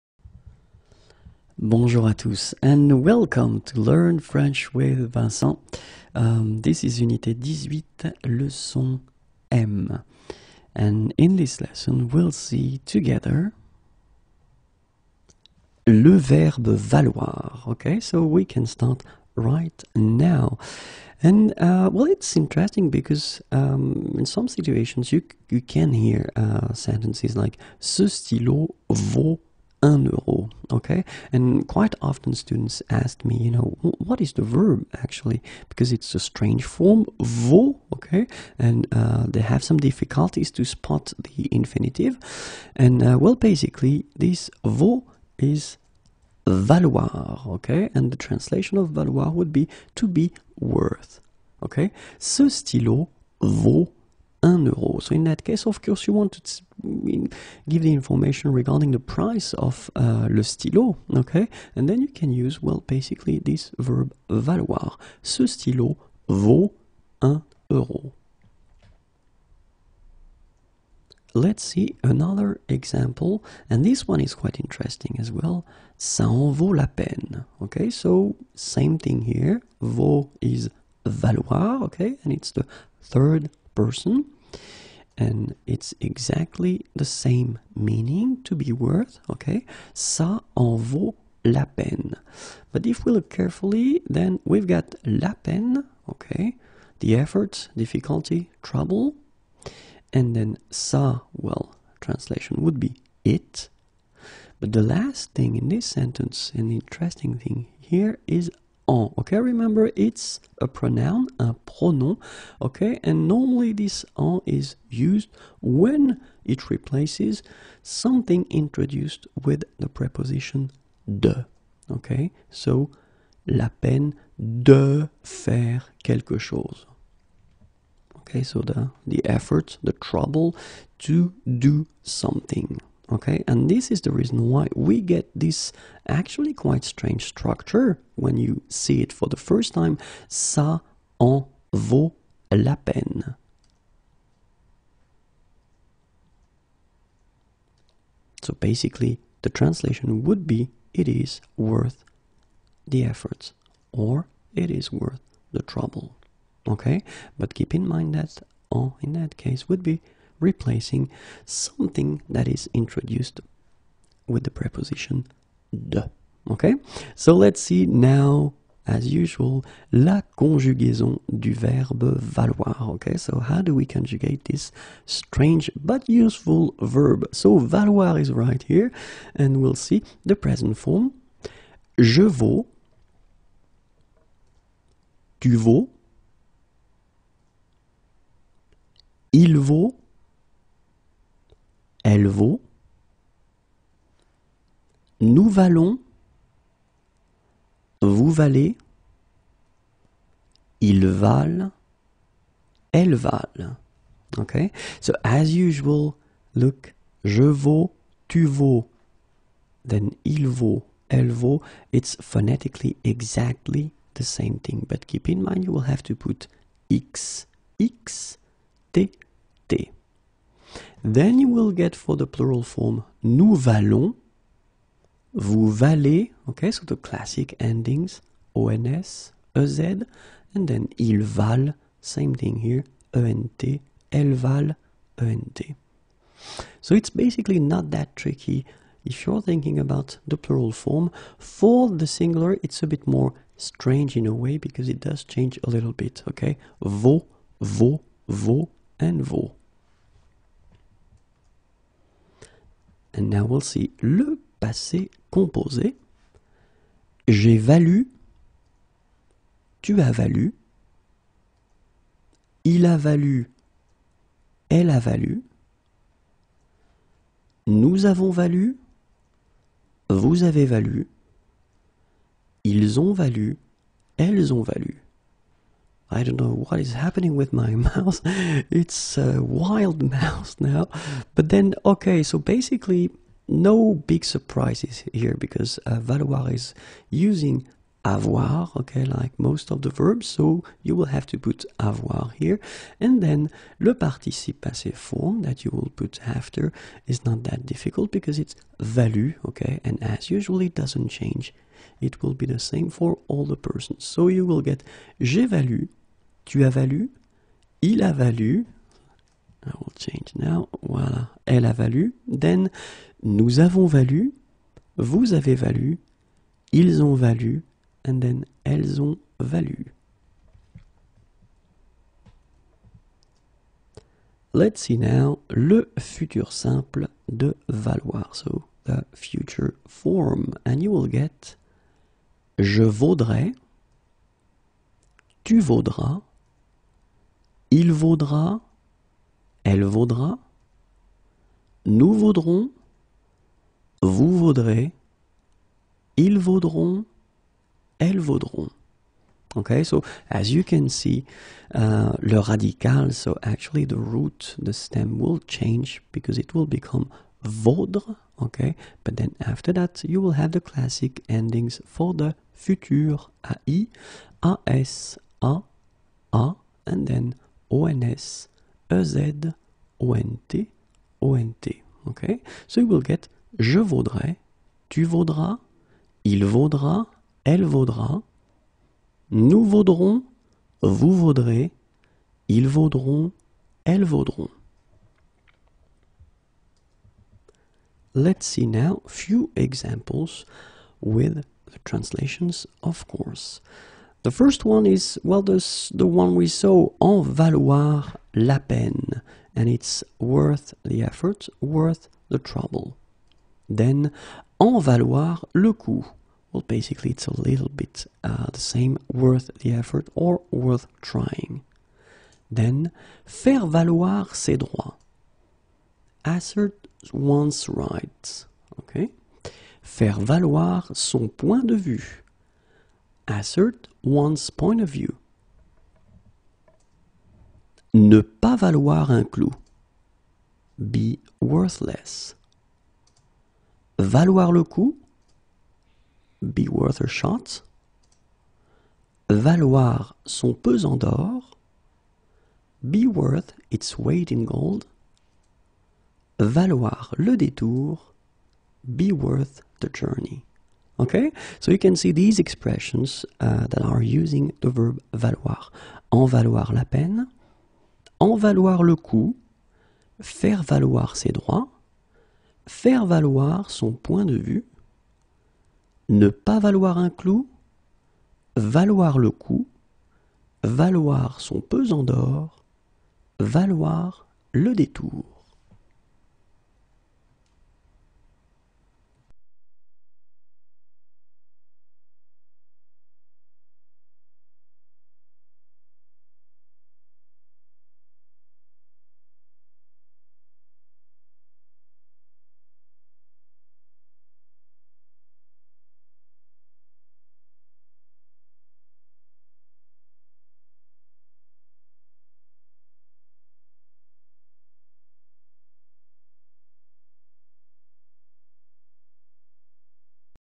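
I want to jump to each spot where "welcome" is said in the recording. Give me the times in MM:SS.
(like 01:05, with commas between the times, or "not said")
00:03.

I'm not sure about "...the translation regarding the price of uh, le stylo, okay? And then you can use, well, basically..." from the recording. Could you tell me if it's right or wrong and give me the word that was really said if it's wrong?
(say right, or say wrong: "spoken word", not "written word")
wrong: "information", not "translation".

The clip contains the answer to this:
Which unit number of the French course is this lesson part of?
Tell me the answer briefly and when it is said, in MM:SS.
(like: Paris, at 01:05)
18, at 00:07.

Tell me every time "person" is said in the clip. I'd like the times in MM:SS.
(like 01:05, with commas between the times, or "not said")
01:23, 05:03.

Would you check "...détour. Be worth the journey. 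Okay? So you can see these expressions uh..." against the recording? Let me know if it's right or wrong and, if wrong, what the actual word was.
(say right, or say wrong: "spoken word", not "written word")
right.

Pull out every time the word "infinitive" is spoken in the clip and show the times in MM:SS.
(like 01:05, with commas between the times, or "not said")
00:41.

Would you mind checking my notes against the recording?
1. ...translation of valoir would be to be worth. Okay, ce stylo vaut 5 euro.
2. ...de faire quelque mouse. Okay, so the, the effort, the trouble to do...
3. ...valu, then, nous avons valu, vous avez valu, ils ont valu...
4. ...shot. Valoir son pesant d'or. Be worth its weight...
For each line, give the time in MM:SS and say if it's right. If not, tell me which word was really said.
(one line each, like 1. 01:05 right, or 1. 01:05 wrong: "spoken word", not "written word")
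1. 00:48 wrong: "1", not "5"
2. 02:04 wrong: "chose", not "mouse"
3. 05:11 right
4. 07:17 right.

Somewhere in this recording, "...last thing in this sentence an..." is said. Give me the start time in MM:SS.
01:44.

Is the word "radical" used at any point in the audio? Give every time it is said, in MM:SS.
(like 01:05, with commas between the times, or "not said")
05:52.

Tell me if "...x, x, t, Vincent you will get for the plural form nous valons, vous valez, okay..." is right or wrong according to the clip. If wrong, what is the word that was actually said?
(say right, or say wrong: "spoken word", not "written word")
wrong: "Then", not "Vincent".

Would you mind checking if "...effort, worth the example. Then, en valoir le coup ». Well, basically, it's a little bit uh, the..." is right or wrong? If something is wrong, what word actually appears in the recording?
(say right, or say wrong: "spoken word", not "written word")
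wrong: "trouble", not "example".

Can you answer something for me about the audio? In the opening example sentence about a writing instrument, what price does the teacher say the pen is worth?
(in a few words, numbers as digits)
1 euro.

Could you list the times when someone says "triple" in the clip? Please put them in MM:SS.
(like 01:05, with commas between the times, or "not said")
not said.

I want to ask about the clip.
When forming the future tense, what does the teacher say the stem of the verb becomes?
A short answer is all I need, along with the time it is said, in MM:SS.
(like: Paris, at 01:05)
vaudre, at 05:57.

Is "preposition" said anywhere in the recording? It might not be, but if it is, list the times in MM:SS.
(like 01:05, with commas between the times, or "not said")
01:59, 02:44.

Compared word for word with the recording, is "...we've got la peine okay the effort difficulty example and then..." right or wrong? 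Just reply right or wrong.
wrong.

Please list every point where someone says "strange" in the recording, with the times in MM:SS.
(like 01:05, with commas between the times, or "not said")
00:36, 02:16, 02:55, 04:03.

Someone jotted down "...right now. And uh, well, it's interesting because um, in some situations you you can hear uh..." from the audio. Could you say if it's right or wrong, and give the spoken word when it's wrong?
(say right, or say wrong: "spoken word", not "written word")
right.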